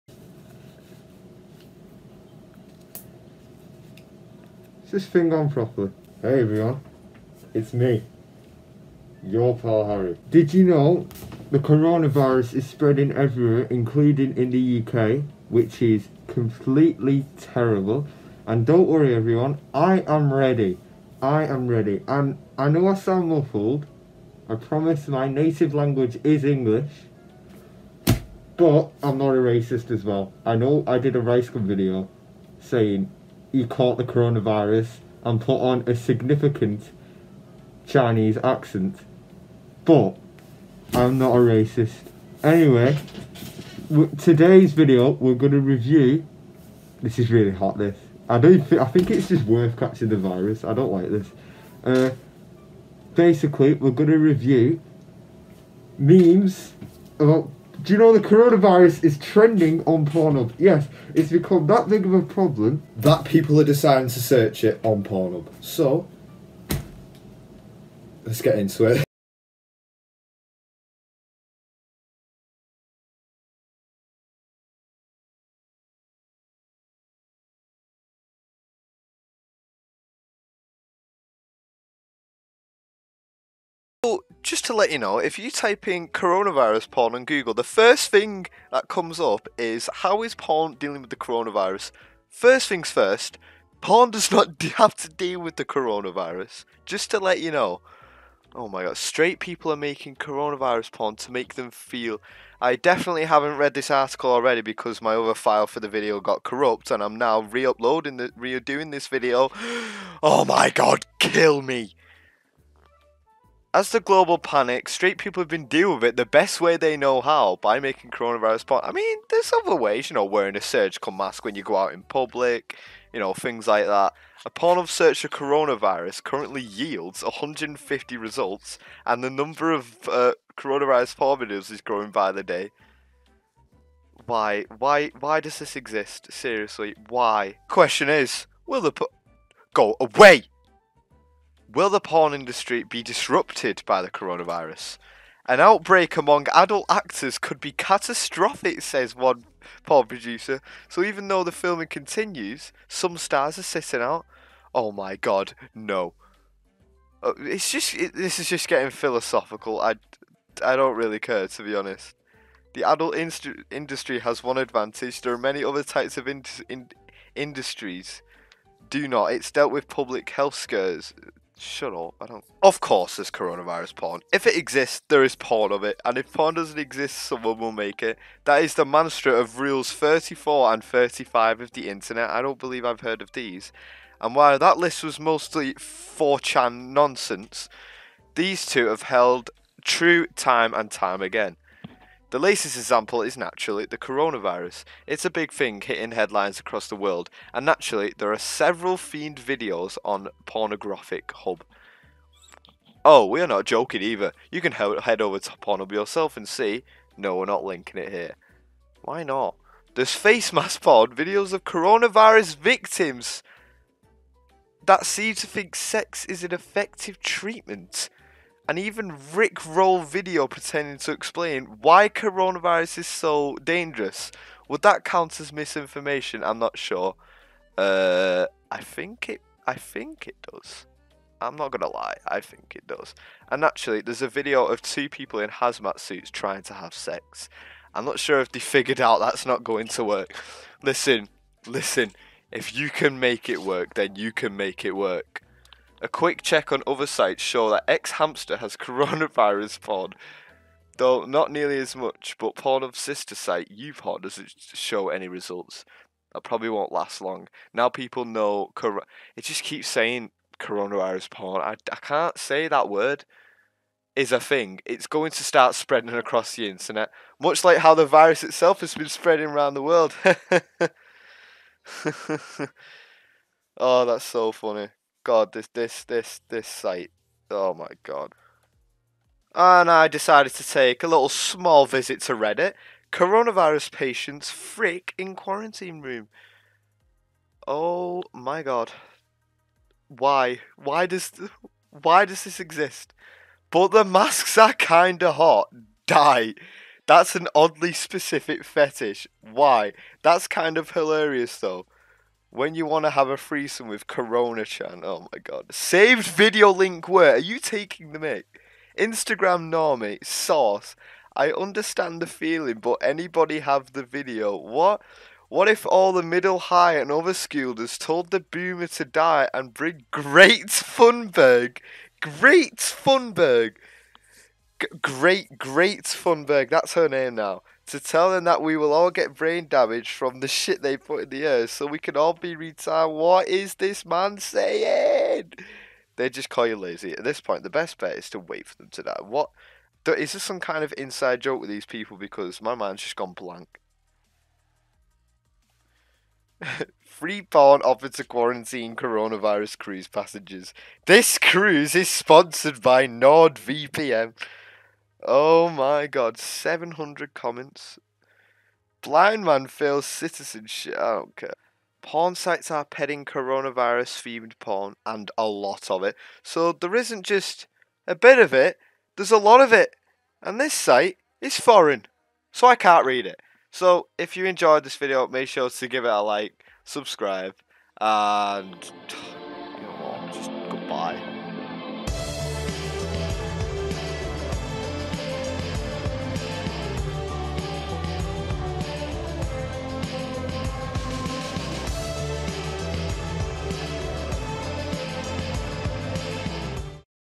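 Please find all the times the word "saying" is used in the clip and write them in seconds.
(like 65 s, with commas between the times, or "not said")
32 s, 259 s, 334 s.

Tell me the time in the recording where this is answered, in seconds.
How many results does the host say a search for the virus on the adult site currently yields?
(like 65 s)
127 s.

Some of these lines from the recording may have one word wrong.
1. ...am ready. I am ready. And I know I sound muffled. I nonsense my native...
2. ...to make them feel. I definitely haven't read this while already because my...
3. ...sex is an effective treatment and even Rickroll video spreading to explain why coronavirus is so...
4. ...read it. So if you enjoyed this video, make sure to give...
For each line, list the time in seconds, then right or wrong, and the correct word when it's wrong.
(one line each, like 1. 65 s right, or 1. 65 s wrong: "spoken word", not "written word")
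1. 20 s wrong: "promise", not "nonsense"
2. 101 s wrong: "article", not "while"
3. 215 s wrong: "pretending", not "spreading"
4. 373 s right.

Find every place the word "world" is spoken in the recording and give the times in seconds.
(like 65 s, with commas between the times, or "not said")
196 s, 269 s.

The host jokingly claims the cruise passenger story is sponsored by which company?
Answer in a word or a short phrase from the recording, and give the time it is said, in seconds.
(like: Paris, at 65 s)
NordVPN, at 353 s.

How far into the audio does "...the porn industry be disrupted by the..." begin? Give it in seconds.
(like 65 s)
141 s.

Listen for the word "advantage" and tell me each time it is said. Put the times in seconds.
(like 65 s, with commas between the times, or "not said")
164 s.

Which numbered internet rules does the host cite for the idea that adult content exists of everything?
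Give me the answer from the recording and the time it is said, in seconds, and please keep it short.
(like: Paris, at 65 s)
34 and 35, at 179 s.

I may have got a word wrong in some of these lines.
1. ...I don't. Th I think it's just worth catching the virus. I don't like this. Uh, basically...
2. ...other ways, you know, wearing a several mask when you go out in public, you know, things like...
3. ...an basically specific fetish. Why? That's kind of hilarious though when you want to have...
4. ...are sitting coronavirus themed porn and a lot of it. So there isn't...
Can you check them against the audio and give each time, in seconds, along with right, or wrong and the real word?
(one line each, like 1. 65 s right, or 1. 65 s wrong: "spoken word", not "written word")
1. 48 s right
2. 119 s wrong: "surgical", not "several"
3. 297 s wrong: "oddly", not "basically"
4. 362 s wrong: "petting", not "sitting".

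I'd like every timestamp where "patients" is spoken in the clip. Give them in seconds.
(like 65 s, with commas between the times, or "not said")
283 s.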